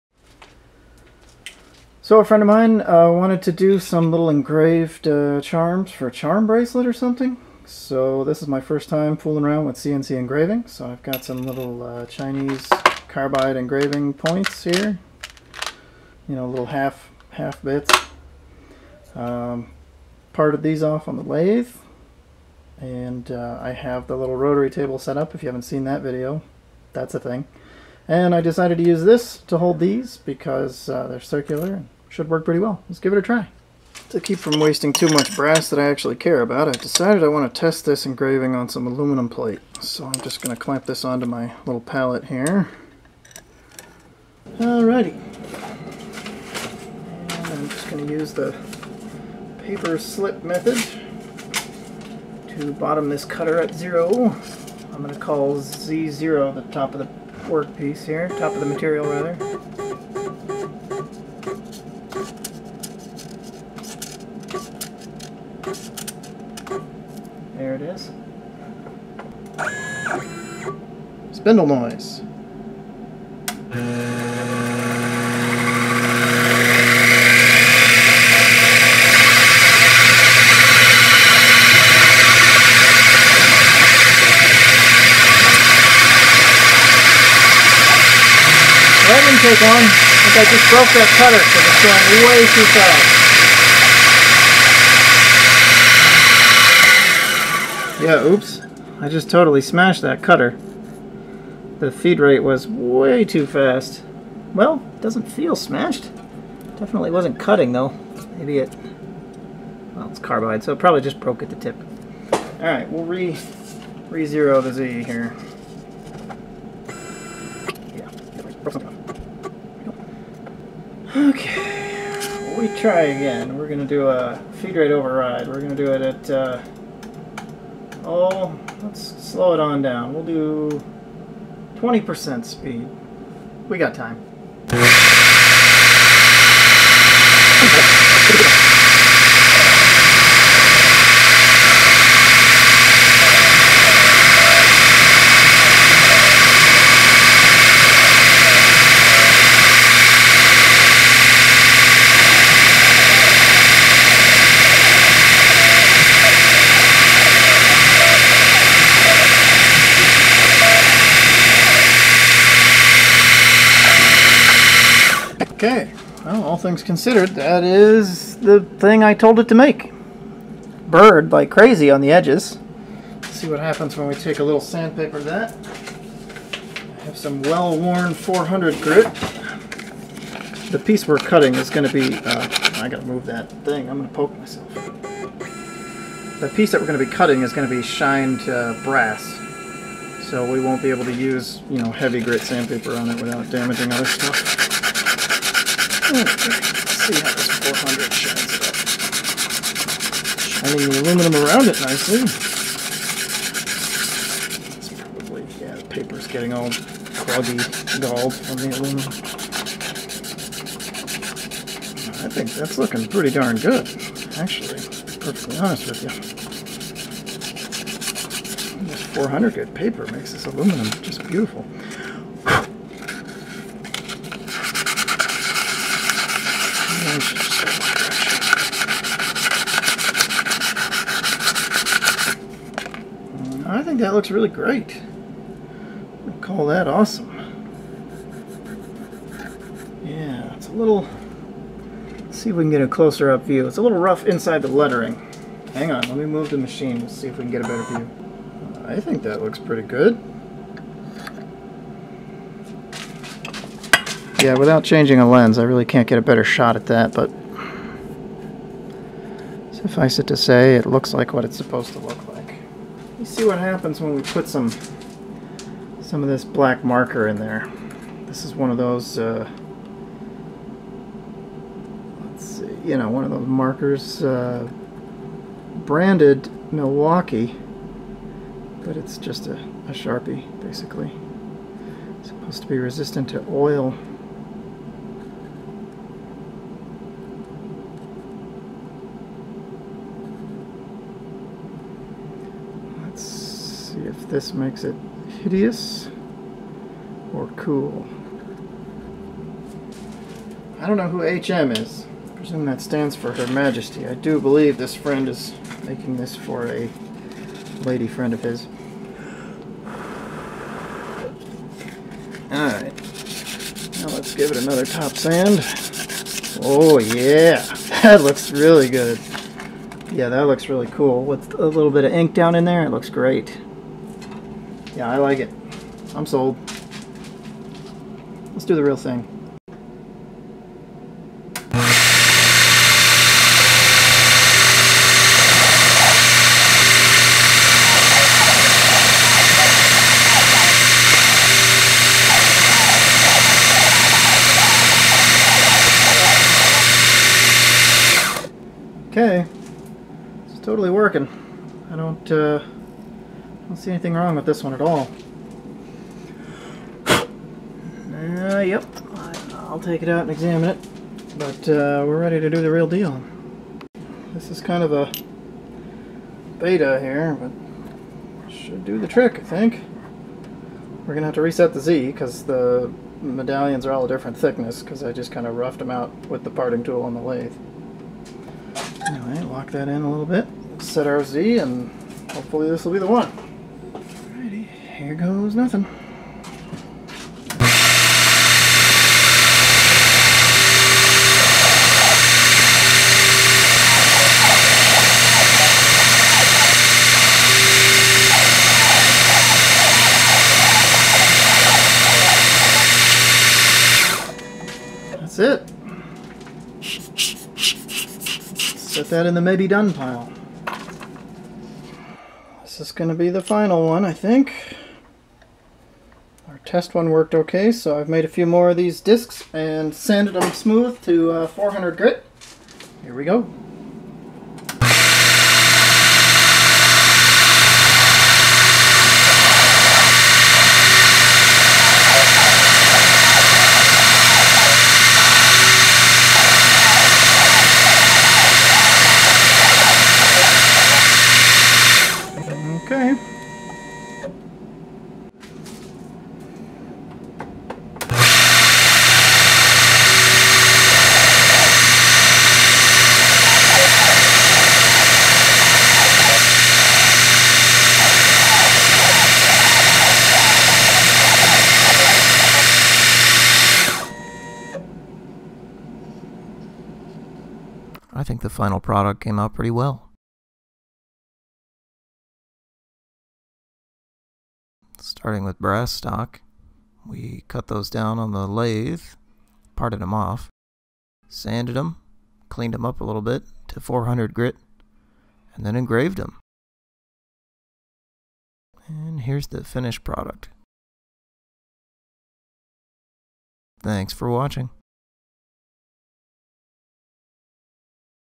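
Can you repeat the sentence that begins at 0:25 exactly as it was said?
If you haven't seen that video, that's a thing.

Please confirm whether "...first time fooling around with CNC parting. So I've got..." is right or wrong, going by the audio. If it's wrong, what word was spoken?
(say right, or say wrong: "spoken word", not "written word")
wrong: "engraving", not "parting".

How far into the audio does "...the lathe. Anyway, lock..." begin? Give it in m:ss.
6:17.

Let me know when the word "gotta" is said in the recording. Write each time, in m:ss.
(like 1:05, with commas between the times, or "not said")
3:02.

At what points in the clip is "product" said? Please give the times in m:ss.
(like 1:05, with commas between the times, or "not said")
7:48, 8:10.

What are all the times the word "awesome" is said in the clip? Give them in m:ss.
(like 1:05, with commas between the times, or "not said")
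3:56.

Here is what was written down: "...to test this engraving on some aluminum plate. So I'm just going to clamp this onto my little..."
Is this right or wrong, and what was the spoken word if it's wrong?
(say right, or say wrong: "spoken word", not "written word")
right.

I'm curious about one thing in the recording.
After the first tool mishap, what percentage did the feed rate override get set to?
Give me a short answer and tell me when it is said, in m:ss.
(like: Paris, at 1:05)
20%, at 2:11.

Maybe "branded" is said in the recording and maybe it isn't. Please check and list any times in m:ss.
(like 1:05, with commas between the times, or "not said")
4:35.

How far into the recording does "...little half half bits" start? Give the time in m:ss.
0:16.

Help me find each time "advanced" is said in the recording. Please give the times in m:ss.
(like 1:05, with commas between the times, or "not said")
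not said.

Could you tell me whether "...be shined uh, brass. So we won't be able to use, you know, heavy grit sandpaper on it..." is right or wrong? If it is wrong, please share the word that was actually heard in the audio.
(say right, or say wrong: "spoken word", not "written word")
right.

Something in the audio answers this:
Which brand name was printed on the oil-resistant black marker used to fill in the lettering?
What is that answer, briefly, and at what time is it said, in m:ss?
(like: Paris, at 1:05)
Milwaukee, at 4:36.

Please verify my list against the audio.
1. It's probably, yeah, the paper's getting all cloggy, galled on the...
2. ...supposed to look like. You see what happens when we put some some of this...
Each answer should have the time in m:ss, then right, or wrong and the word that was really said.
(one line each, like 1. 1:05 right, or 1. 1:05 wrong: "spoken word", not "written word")
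1. 3:24 right
2. 4:21 right.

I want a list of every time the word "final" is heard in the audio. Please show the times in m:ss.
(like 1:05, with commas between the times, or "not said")
6:53, 7:48.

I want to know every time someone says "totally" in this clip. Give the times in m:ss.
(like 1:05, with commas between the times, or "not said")
1:39, 5:50.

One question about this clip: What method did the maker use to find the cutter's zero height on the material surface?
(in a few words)
Paper slip method.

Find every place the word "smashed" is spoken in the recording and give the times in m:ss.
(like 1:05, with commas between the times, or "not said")
1:39, 1:45.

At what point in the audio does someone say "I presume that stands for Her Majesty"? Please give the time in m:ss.
5:02.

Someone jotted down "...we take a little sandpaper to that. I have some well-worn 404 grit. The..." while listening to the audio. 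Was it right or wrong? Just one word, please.
wrong.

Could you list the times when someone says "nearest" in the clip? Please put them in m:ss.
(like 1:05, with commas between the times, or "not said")
not said.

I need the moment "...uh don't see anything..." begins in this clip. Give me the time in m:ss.
5:52.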